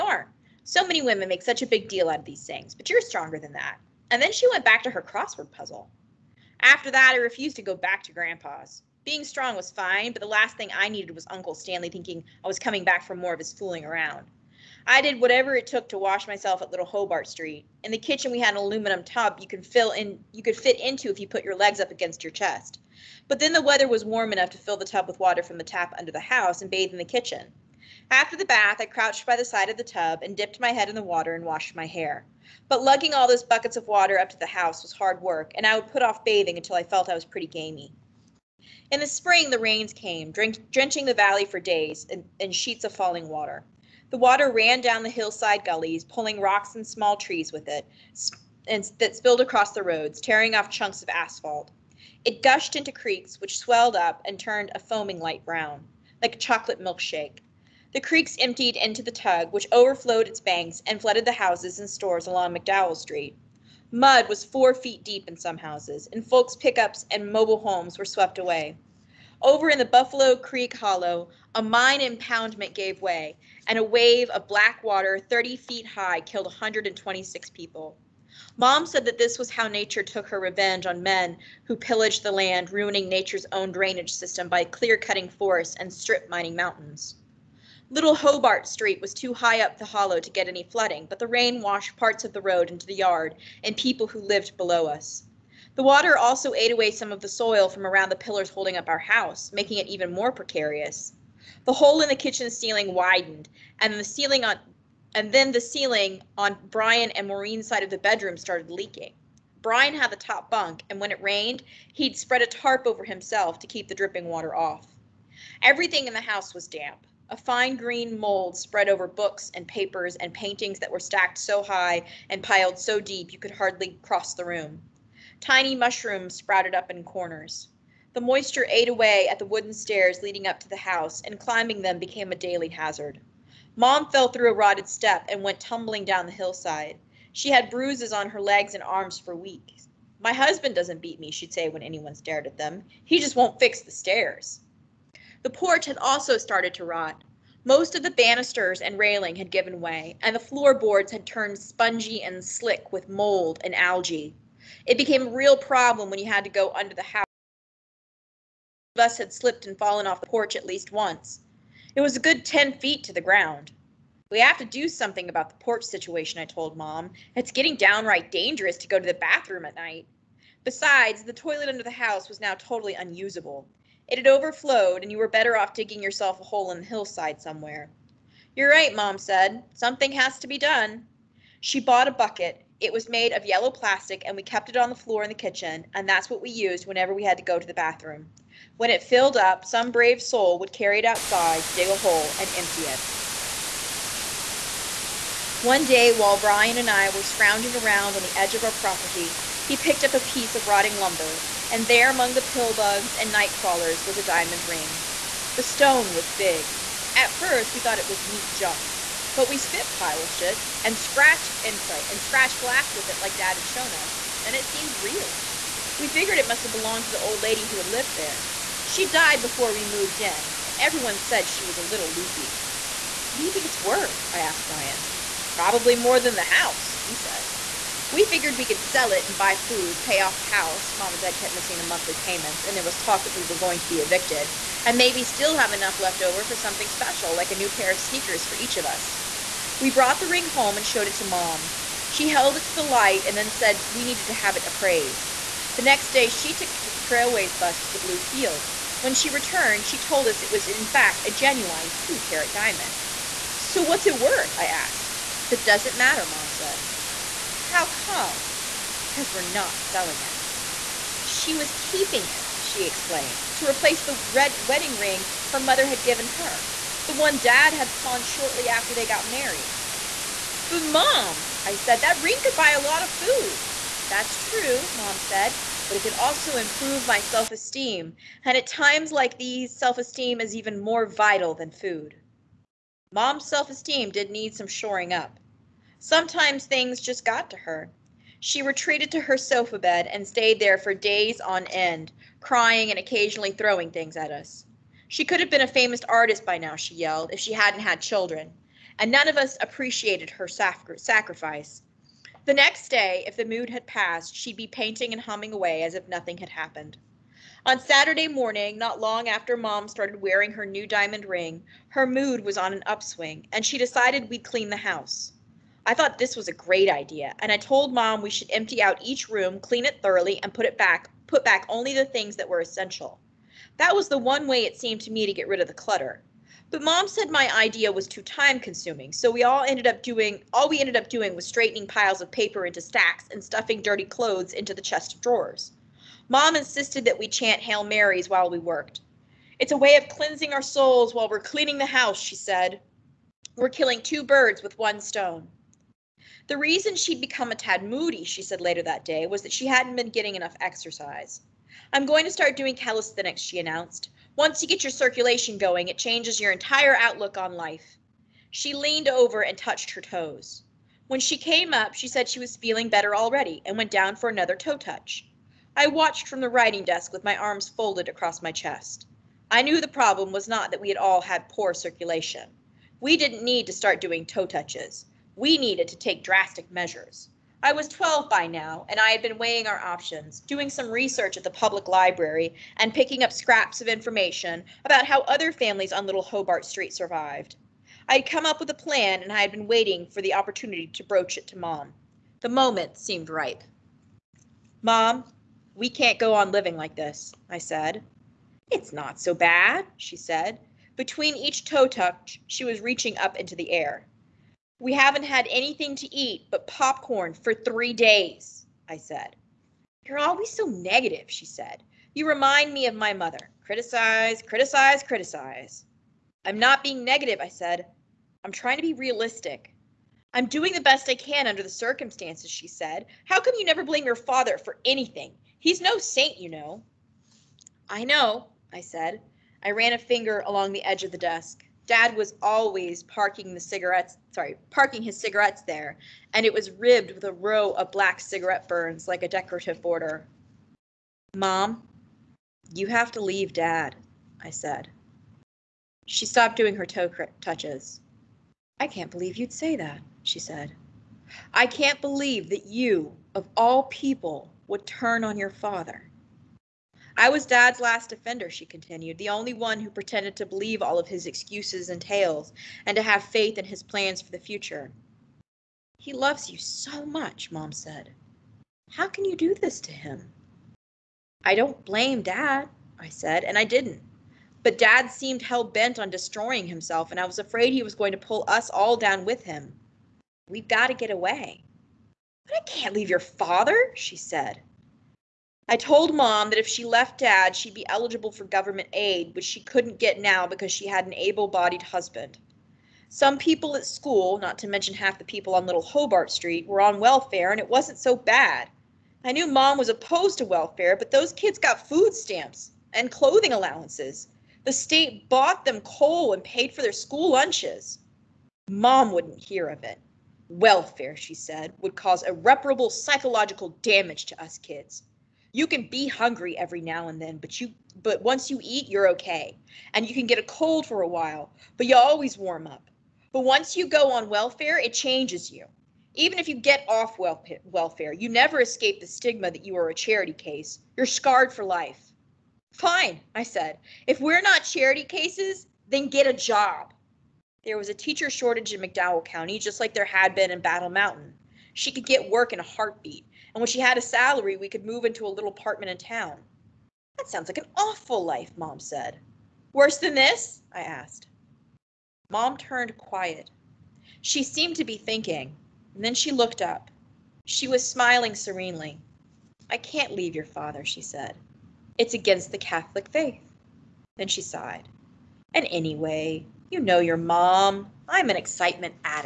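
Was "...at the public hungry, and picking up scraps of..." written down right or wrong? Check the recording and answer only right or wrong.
wrong.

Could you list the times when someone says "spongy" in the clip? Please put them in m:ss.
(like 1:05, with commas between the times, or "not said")
2:31.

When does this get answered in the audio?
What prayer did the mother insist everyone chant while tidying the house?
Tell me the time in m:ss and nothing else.
5:37.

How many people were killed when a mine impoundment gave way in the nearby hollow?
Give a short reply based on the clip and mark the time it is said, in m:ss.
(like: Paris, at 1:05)
126, at 1:16.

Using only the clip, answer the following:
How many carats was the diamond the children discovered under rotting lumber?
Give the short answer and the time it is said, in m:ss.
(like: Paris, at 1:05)
2, at 4:11.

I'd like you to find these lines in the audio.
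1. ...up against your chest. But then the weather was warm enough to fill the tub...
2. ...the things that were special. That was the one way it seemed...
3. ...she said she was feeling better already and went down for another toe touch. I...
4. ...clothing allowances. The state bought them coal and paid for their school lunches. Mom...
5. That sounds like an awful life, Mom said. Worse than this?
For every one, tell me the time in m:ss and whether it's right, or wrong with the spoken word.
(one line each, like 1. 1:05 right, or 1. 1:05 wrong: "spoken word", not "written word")
1. 0:21 right
2. 5:21 wrong: "essential", not "special"
3. 6:01 right
4. 8:23 right
5. 9:07 right.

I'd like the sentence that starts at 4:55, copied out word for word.
She could have been a famous artist by now, she yelled, if she hadn't had children.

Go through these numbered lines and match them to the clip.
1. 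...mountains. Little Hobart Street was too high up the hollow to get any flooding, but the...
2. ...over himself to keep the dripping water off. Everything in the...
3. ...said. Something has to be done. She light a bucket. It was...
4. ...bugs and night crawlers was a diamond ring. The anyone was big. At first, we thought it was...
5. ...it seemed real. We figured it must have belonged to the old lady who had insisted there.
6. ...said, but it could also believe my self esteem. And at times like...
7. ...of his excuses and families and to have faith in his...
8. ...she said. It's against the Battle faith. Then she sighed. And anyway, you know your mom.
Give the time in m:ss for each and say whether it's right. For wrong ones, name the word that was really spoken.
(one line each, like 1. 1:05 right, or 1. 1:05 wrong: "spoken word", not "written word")
1. 1:26 right
2. 1:52 right
3. 2:59 wrong: "bought", not "light"
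4. 3:22 wrong: "stone", not "anyone"
5. 3:34 wrong: "lived", not "insisted"
6. 4:35 wrong: "improve", not "believe"
7. 7:40 wrong: "tales", not "families"
8. 9:20 wrong: "Catholic", not "Battle".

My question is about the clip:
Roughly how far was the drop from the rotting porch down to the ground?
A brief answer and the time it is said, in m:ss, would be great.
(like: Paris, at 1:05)
10 feet, at 2:42.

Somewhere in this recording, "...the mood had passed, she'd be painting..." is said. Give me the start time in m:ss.
5:03.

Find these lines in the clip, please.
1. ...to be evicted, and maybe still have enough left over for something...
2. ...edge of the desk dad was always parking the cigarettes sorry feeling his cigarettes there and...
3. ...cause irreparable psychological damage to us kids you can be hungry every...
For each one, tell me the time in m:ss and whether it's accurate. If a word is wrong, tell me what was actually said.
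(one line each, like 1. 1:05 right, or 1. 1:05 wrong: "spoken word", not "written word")
1. 3:53 right
2. 7:10 wrong: "parking", not "feeling"
3. 8:31 right.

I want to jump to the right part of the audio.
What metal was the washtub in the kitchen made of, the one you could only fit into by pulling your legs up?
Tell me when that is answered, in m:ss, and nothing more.
0:18.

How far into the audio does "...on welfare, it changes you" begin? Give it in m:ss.
8:44.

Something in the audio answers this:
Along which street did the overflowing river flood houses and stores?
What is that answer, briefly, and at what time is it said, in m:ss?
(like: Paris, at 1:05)
McDowell Street, at 1:02.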